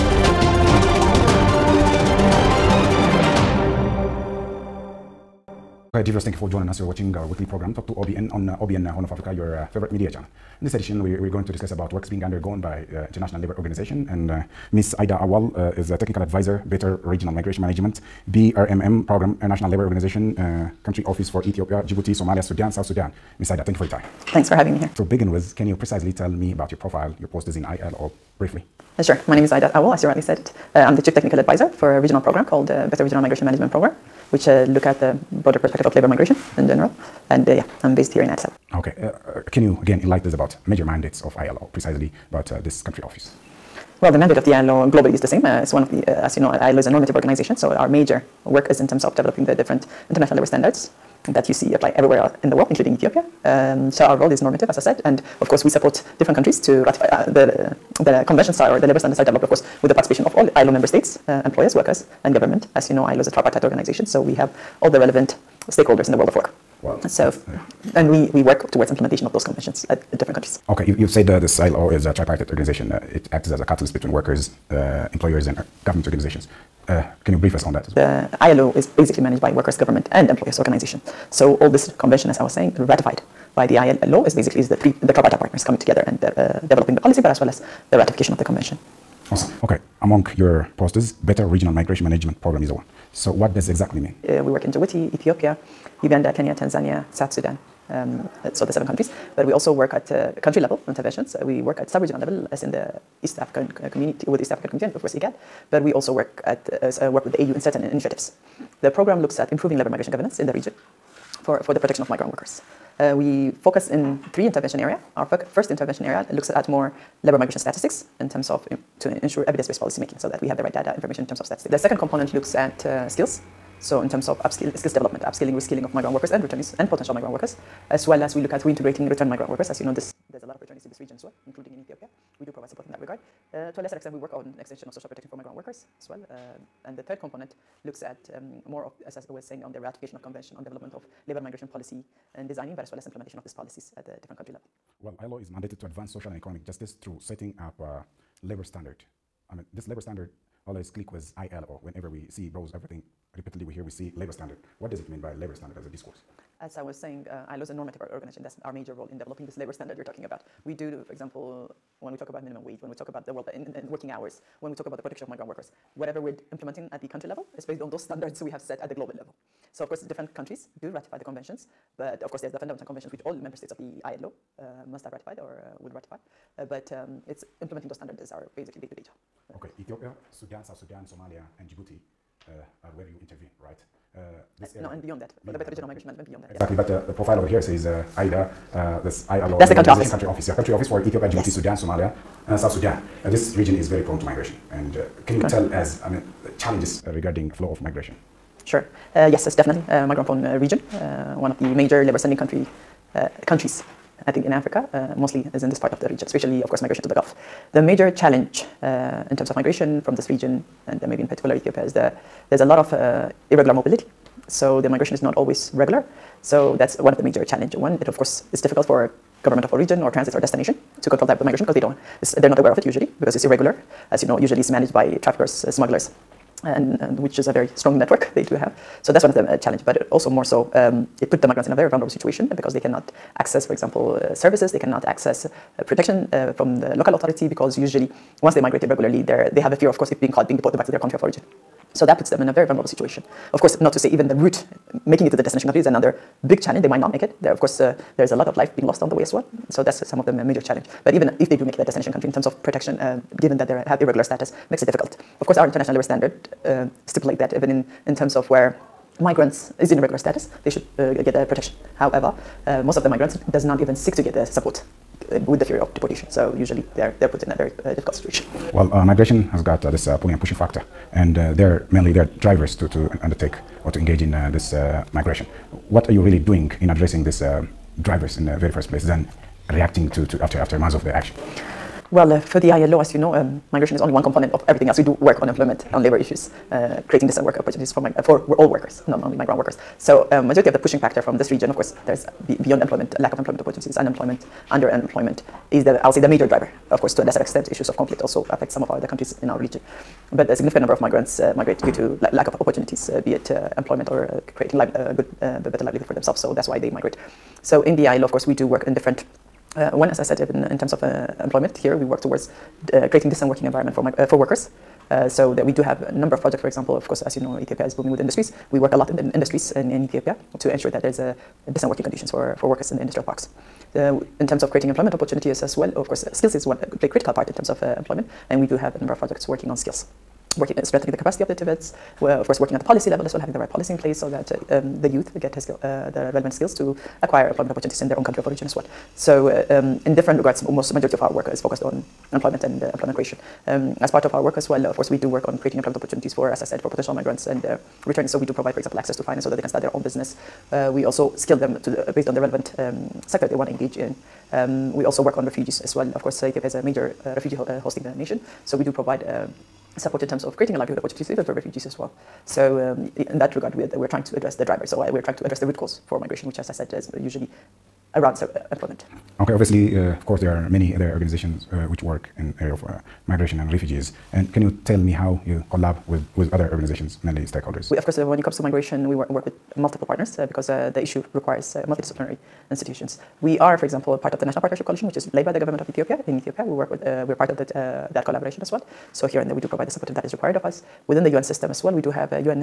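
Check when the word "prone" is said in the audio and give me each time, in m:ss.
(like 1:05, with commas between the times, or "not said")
3:14, 3:20.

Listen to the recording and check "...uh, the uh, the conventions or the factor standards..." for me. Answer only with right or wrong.
wrong.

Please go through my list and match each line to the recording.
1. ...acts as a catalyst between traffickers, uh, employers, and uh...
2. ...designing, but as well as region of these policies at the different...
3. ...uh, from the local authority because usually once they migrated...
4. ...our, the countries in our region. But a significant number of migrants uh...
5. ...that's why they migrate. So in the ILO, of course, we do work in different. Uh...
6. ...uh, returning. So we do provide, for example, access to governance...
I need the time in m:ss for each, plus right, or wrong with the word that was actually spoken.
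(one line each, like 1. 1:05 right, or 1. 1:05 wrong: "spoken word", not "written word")
1. 1:13 wrong: "workers", not "traffickers"
2. 2:22 wrong: "implementation", not "region"
3. 3:56 right
4. 4:58 right
5. 5:06 right
6. 5:47 wrong: "finance", not "governance".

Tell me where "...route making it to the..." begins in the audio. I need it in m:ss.
4:04.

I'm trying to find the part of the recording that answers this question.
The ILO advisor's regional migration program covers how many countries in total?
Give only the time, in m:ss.
1:38.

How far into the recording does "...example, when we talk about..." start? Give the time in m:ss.
2:41.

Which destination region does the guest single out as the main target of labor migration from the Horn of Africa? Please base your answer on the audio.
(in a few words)
the Gulf.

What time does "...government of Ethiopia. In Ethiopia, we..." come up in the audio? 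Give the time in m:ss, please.
6:25.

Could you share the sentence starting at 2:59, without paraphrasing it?
Uh, okay, Ethiopia, Sudan, South Sudan, Somalia, and Djibouti uh, are where you intervene, right?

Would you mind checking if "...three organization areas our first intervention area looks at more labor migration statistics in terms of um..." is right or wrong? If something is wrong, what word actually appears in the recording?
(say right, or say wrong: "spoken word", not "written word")
wrong: "intervention", not "organization".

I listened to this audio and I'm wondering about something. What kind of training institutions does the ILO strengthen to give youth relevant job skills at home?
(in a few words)
TVETs.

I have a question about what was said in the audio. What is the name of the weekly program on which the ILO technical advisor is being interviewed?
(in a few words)
Talk to OBN.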